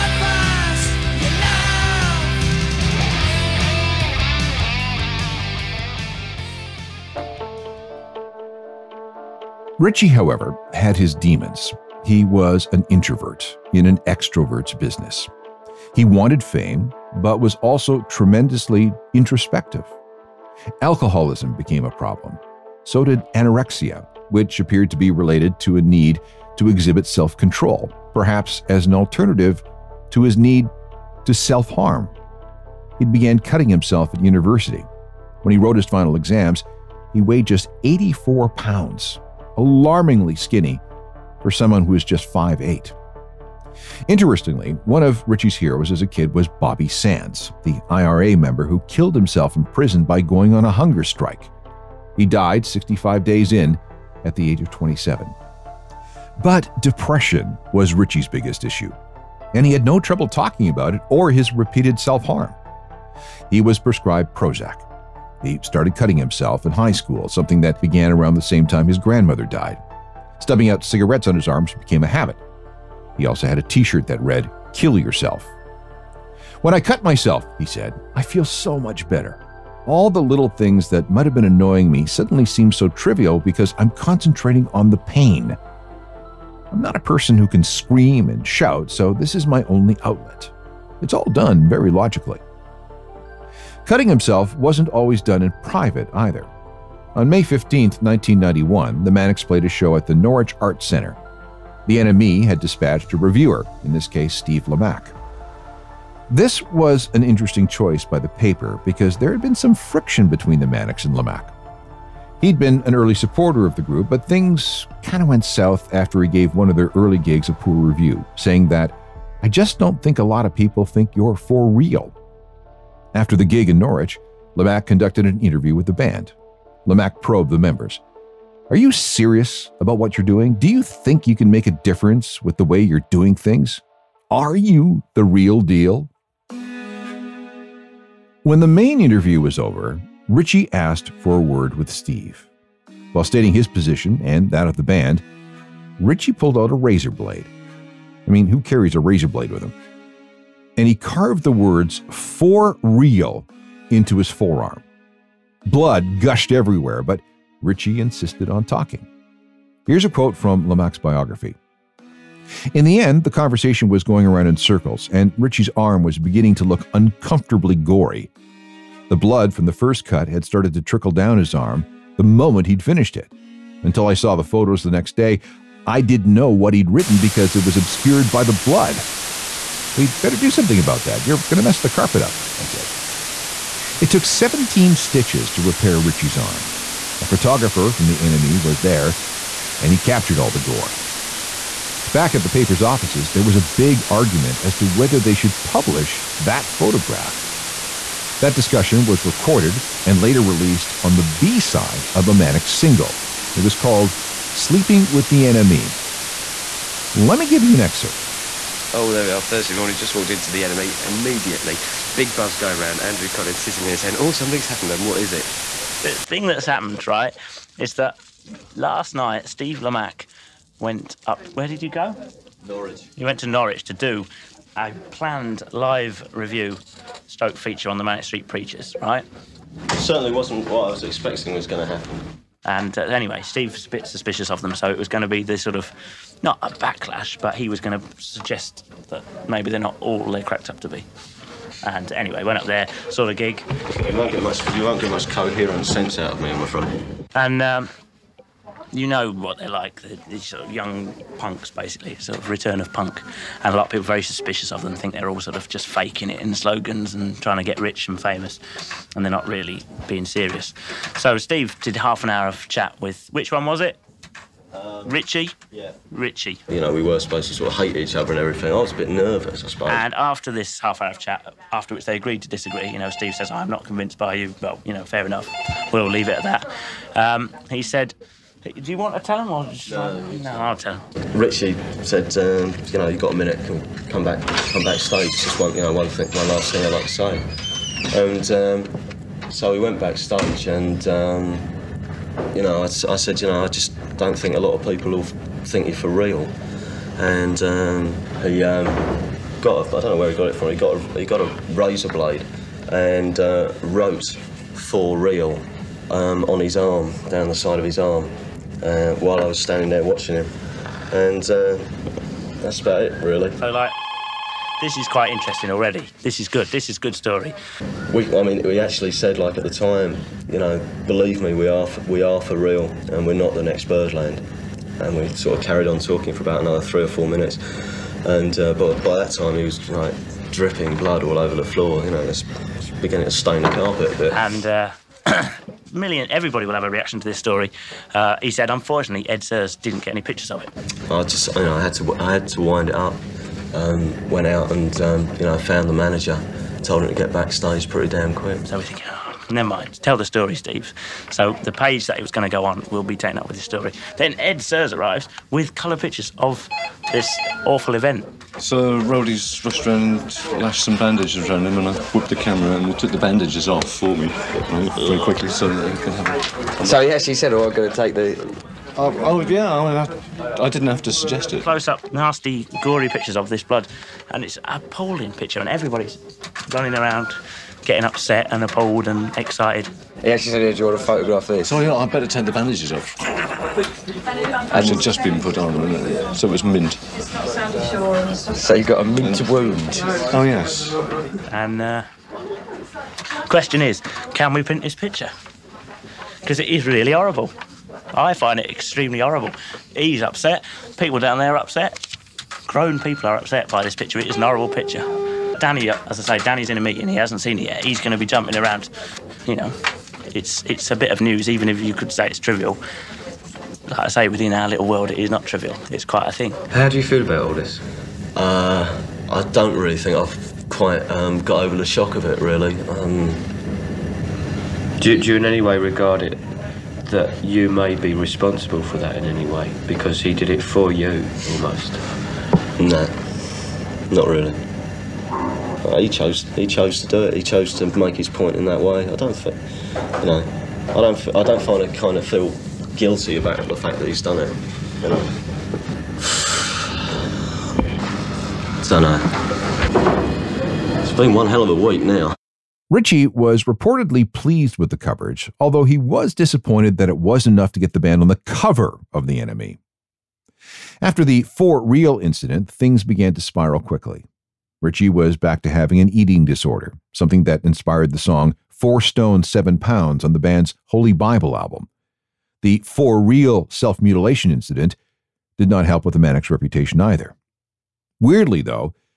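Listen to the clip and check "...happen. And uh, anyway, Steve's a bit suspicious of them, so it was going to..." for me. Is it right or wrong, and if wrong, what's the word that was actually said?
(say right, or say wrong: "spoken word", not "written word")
right.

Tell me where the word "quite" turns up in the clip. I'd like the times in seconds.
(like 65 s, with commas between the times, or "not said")
315 s, 416 s, 420 s.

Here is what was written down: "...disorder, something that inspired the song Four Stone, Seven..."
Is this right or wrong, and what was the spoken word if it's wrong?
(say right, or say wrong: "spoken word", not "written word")
right.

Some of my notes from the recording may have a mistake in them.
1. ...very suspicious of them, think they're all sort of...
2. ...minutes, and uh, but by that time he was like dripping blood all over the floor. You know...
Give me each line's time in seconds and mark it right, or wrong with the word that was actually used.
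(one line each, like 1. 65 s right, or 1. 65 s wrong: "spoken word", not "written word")
1. 254 s right
2. 327 s right.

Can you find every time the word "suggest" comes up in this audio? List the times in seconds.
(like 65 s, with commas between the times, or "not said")
238 s, 371 s.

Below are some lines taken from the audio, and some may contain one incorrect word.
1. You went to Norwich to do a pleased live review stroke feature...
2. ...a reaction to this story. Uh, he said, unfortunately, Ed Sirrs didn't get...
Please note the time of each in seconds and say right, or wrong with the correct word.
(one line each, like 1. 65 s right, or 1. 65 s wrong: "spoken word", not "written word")
1. 223 s wrong: "planned", not "pleased"
2. 336 s right.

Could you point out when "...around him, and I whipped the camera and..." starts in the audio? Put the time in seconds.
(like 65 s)
361 s.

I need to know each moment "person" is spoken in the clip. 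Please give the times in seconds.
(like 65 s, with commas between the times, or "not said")
87 s.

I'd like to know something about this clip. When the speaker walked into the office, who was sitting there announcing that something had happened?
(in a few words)
Andrew Collins.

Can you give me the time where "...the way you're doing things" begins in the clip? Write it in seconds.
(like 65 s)
132 s.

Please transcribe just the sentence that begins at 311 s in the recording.
And uh, that's about it, really.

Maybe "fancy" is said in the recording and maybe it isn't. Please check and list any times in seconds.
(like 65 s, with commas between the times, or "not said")
not said.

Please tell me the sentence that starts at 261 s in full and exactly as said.
So Steve did half an hour of chat with which one was it?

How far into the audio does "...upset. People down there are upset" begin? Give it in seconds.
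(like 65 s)
400 s.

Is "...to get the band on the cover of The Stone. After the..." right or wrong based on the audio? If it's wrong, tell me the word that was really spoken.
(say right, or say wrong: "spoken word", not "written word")
wrong: "NME", not "Stone".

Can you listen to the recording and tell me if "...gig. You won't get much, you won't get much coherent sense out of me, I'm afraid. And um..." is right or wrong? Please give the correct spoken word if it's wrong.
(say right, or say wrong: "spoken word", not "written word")
right.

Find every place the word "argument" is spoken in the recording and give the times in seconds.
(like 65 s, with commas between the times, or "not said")
194 s.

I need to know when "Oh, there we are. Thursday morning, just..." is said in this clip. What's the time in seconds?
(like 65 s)
208 s.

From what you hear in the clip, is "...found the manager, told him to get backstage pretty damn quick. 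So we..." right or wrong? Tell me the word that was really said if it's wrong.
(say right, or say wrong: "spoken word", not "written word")
right.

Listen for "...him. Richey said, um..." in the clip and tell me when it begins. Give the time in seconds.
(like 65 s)
280 s.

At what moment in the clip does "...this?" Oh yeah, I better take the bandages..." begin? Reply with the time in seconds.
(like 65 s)
381 s.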